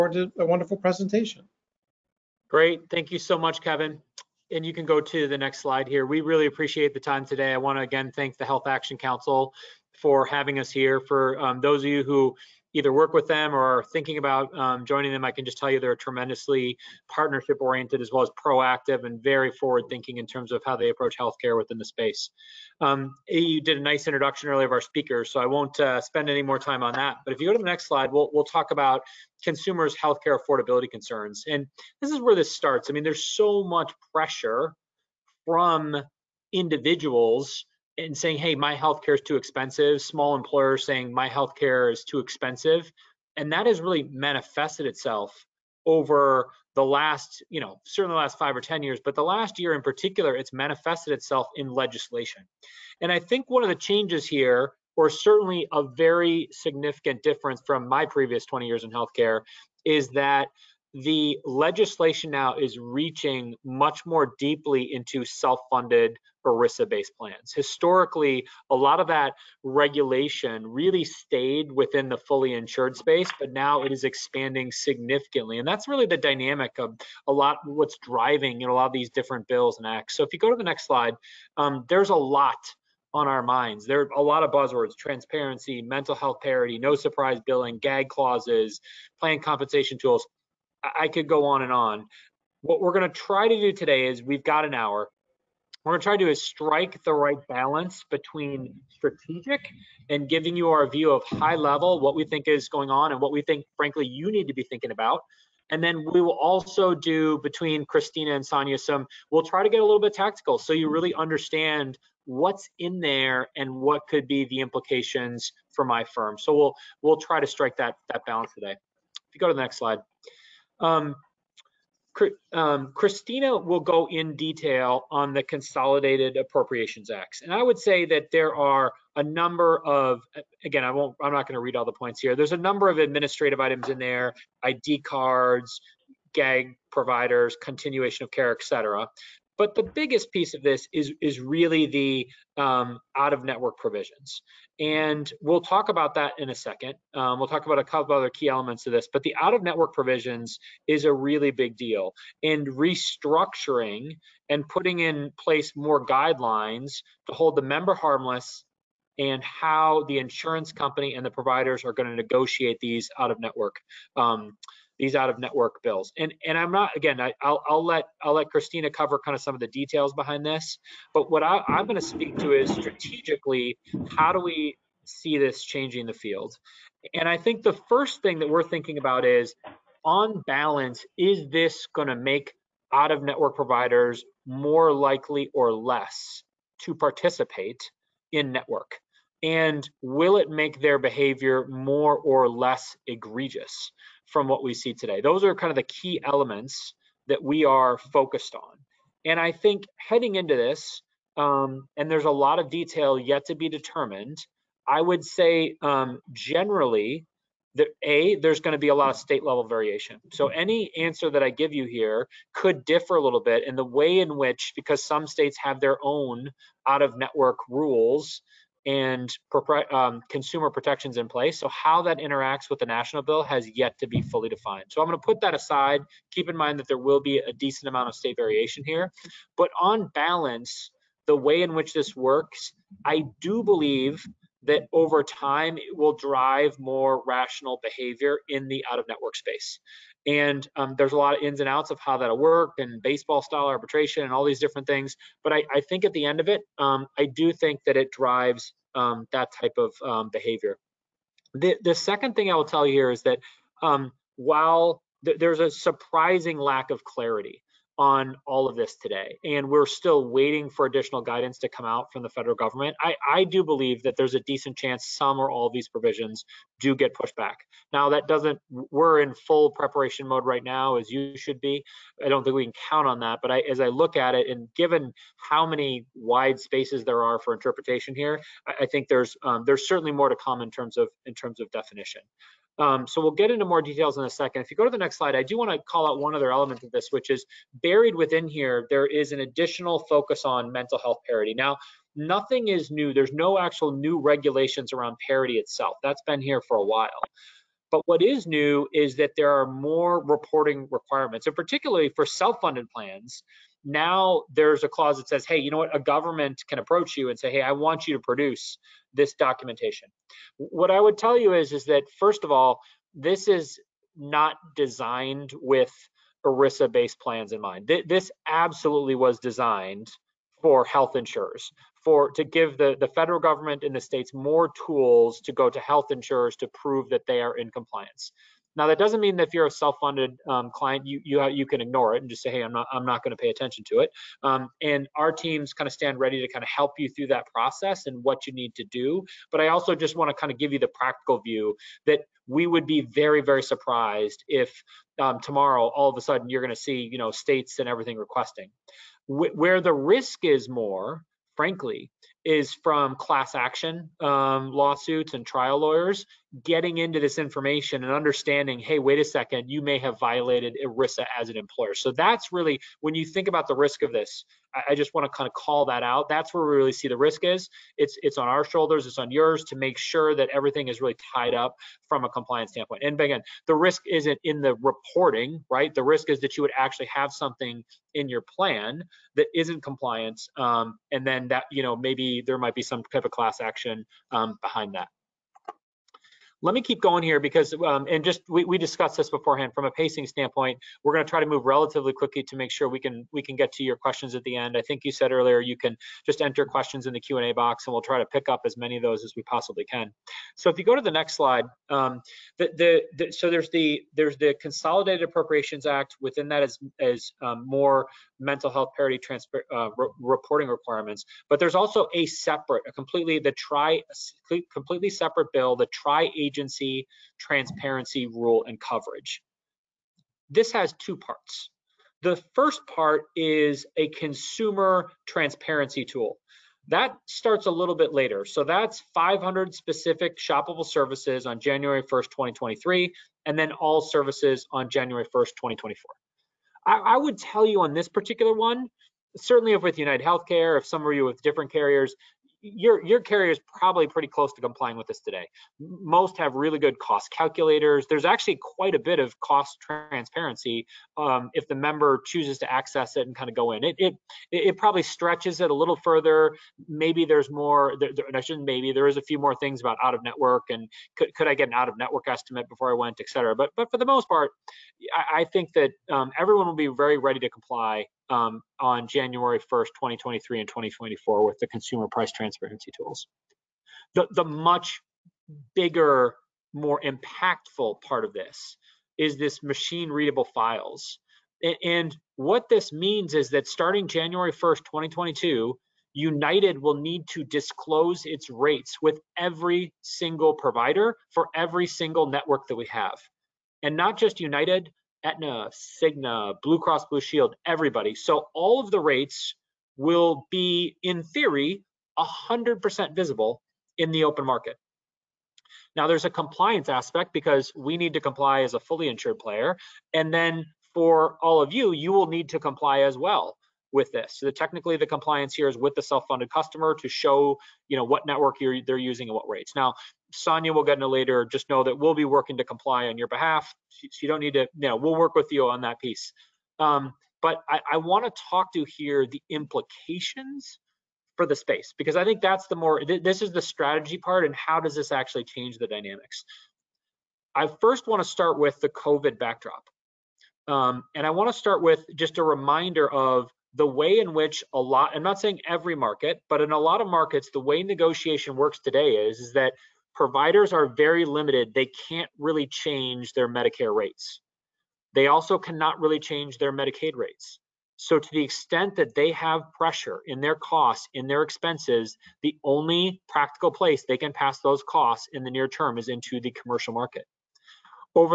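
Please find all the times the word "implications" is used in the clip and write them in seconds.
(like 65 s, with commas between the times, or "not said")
114 s, 529 s.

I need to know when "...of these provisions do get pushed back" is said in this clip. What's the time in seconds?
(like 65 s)
265 s.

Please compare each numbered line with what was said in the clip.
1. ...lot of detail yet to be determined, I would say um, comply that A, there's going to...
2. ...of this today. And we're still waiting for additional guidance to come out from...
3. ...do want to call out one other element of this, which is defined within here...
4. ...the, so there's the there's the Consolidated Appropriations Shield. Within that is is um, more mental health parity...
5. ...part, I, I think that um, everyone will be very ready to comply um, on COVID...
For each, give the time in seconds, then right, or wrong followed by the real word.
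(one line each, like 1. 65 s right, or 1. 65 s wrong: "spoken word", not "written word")
1. 202 s wrong: "generally", not "comply"
2. 258 s right
3. 285 s wrong: "buried", not "defined"
4. 403 s wrong: "Act", not "Shield"
5. 464 s wrong: "January", not "COVID".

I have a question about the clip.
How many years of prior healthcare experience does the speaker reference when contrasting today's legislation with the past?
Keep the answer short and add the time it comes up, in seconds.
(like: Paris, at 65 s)
20, at 58 s.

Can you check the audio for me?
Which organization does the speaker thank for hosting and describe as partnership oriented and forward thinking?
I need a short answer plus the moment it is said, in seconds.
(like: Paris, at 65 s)
Health Action Council, at 8 s.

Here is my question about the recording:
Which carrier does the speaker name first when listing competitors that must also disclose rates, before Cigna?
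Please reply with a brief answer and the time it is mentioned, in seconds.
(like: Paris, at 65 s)
Aetna, at 495 s.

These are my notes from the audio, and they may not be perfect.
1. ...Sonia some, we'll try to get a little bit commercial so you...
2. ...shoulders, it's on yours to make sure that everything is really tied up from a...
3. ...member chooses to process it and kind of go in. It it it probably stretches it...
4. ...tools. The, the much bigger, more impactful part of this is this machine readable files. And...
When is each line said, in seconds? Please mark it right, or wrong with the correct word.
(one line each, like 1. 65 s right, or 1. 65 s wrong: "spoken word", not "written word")
1. 108 s wrong: "tactical", not "commercial"
2. 368 s right
3. 451 s wrong: "access", not "process"
4. 472 s right.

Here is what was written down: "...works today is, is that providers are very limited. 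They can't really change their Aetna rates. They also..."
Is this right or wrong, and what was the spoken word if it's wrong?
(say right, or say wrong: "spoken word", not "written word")
wrong: "Medicare", not "Aetna".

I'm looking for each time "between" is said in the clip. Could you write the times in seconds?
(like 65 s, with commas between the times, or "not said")
98 s, 107 s.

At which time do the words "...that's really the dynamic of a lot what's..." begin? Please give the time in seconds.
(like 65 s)
75 s.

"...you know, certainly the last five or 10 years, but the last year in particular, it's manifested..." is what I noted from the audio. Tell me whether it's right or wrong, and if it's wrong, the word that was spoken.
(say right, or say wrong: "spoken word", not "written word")
right.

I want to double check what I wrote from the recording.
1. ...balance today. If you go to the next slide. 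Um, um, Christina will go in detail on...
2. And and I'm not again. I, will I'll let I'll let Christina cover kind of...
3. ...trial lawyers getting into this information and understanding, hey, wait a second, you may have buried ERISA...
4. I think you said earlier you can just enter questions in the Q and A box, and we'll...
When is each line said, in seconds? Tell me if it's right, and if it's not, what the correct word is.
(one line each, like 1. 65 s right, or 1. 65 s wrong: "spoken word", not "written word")
1. 118 s right
2. 166 s right
3. 355 s wrong: "violated", not "buried"
4. 394 s right.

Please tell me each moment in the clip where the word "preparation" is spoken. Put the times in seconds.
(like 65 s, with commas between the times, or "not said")
269 s.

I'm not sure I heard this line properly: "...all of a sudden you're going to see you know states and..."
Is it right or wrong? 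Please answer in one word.
right.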